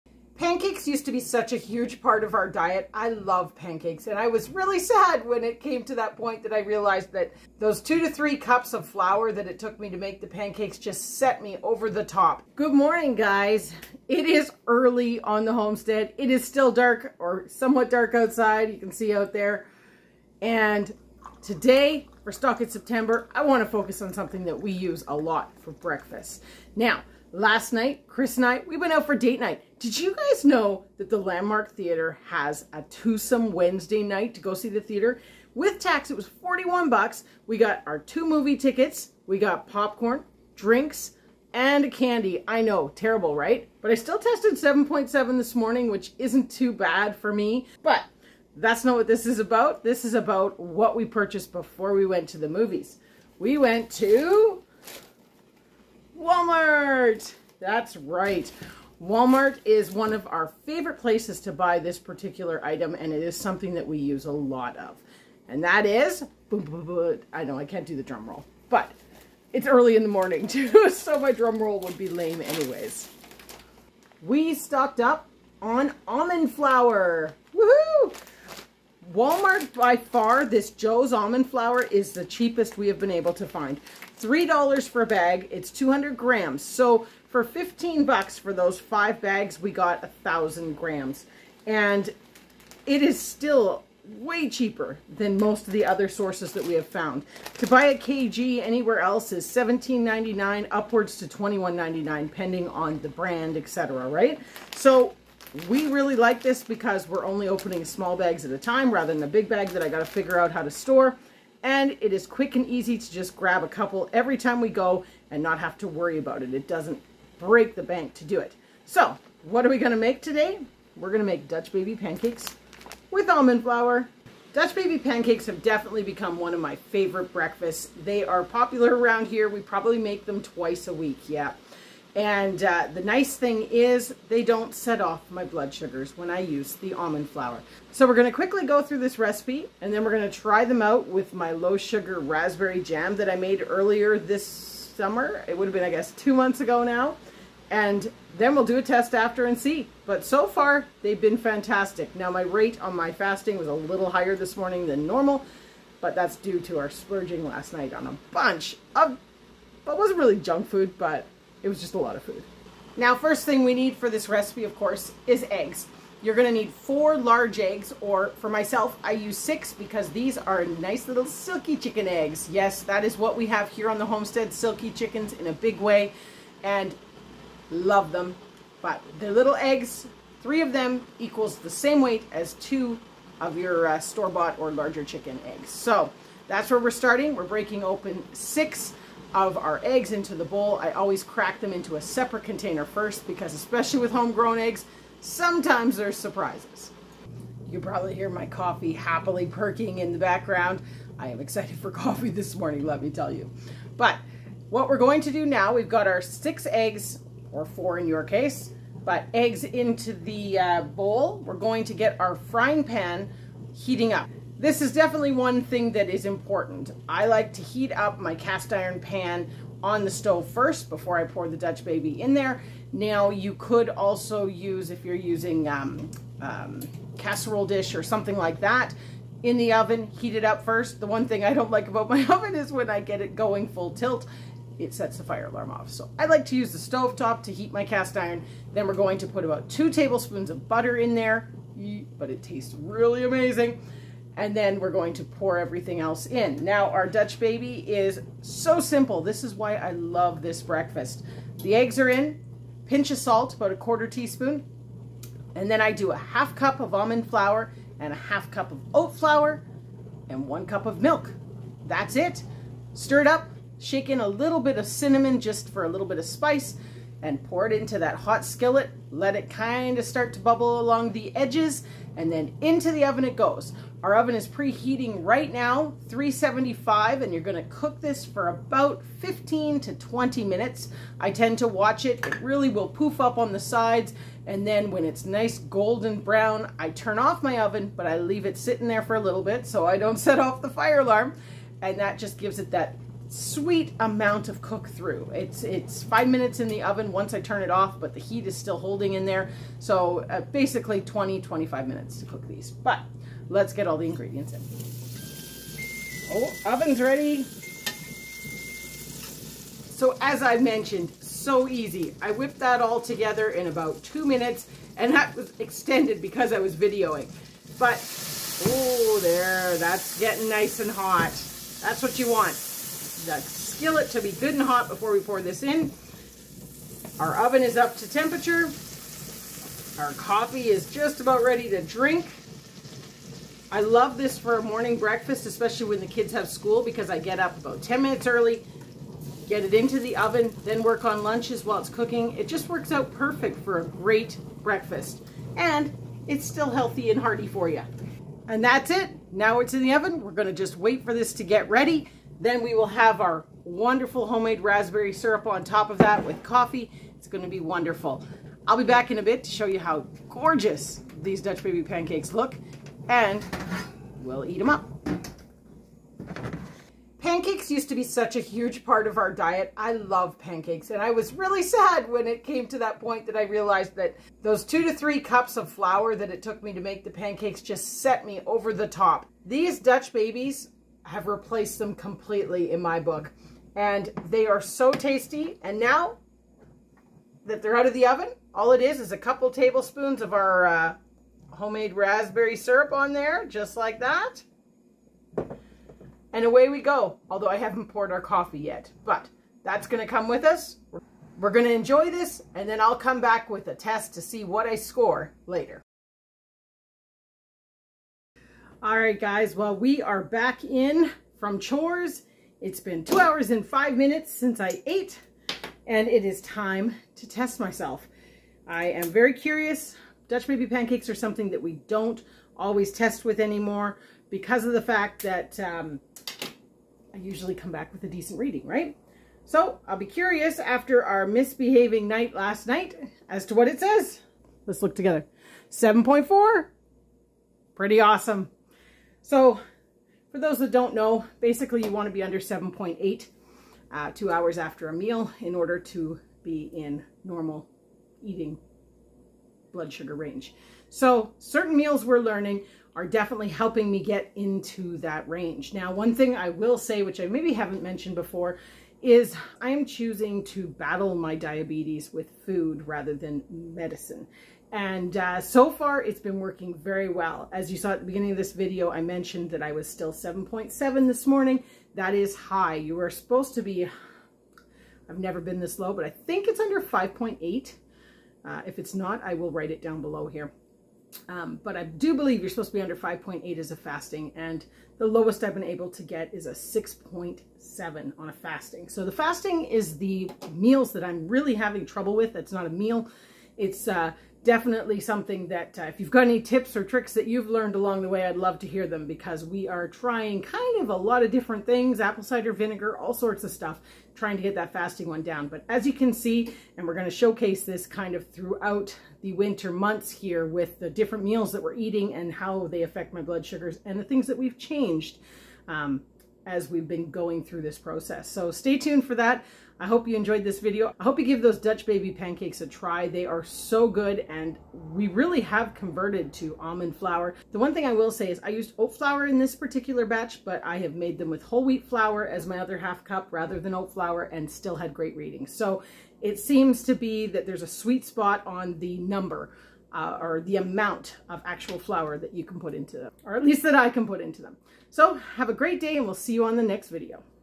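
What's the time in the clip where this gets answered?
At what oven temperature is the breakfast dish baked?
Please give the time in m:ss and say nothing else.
4:36.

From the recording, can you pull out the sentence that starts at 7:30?
So certain meals we're learning are definitely helping me get into that range.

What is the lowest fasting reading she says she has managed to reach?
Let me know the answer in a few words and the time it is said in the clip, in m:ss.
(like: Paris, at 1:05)
6.7, at 8:06.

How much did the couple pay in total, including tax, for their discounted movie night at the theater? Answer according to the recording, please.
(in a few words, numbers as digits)
$41.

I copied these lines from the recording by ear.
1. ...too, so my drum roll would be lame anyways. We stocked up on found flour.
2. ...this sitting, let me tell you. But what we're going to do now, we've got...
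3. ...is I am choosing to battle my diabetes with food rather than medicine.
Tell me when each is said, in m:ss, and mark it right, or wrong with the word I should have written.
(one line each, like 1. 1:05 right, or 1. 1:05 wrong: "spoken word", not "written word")
1. 1:10 wrong: "almond", not "found"
2. 3:22 wrong: "morning", not "sitting"
3. 7:39 right.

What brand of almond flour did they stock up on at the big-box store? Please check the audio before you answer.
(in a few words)
Joe's.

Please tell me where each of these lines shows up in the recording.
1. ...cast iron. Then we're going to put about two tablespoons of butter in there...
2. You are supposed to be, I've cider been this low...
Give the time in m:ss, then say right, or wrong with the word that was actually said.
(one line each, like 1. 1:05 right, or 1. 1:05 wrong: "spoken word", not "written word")
1. 3:57 right
2. 7:52 wrong: "never", not "cider".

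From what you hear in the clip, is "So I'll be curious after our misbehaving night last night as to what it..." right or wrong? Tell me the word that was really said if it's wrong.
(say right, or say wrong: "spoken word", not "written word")
right.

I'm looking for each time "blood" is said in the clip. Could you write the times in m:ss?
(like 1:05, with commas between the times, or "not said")
2:15, 7:29, 8:33.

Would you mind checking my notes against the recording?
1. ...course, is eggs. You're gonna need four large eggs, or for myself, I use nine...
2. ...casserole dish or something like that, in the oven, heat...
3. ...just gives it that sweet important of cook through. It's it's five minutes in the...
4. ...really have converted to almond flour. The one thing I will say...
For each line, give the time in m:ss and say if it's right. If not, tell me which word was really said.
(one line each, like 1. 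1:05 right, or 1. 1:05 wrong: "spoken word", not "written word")
1. 2:44 wrong: "six", not "nine"
2. 3:47 right
3. 4:52 wrong: "amount", not "important"
4. 8:45 right.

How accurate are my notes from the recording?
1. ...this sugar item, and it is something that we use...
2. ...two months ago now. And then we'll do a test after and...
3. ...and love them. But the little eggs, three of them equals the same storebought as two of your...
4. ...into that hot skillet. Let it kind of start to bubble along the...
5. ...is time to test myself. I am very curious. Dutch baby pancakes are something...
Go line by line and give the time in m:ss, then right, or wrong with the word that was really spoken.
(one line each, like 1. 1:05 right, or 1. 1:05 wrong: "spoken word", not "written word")
1. 1:01 wrong: "particular", not "sugar"
2. 2:26 right
3. 2:56 wrong: "weight", not "storebought"
4. 4:27 right
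5. 6:56 right.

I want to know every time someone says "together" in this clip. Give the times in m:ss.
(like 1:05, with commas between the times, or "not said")
5:12, 7:14.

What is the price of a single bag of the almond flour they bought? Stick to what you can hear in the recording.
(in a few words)
$3.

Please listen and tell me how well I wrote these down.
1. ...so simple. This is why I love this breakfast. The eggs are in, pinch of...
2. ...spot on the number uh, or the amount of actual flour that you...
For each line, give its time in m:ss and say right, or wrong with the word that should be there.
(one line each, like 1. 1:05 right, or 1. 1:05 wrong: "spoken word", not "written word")
1. 4:08 right
2. 8:58 right.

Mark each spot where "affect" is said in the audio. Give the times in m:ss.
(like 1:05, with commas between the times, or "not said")
8:32.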